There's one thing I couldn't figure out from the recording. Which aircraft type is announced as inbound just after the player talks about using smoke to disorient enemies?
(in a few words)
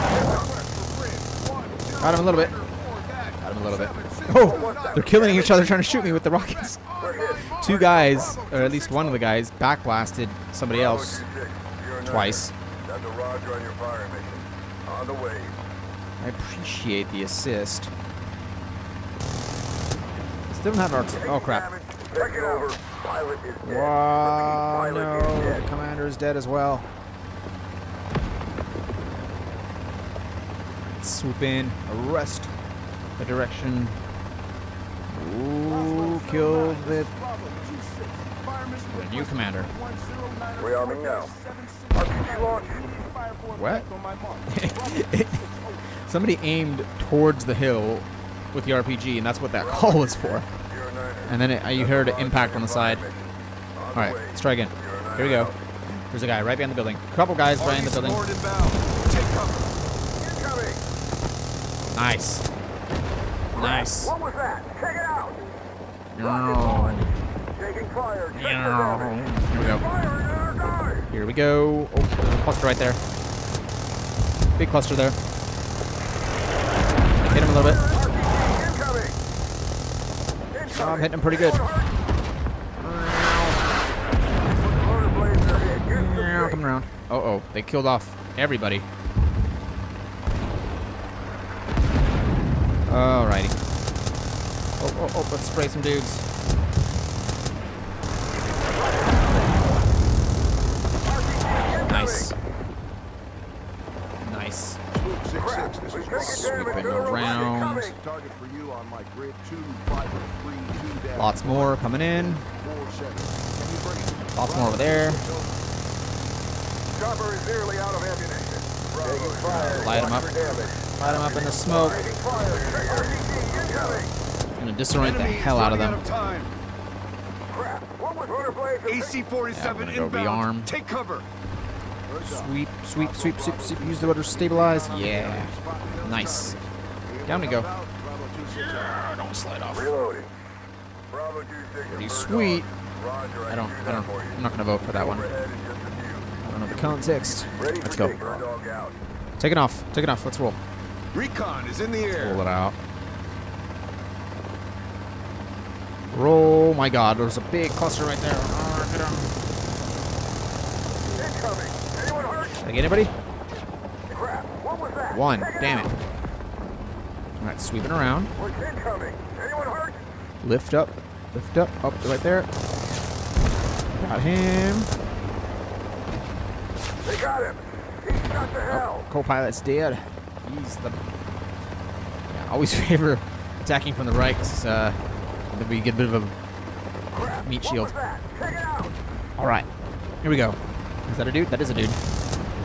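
AC-47.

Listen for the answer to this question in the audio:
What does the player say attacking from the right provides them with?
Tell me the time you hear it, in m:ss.
3:07.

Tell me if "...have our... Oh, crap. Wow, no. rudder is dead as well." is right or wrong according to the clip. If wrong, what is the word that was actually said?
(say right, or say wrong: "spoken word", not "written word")
wrong: "commander", not "rudder".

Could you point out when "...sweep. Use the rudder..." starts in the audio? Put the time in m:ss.
2:13.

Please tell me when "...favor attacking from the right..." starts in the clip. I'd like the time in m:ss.
3:02.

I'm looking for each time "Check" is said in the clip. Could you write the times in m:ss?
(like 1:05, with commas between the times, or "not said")
1:04.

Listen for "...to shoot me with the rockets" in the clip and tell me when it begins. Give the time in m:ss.
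0:05.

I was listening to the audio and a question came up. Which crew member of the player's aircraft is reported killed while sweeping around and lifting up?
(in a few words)
co-pilot.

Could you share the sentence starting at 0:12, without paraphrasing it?
That's a Roger on your fire mission.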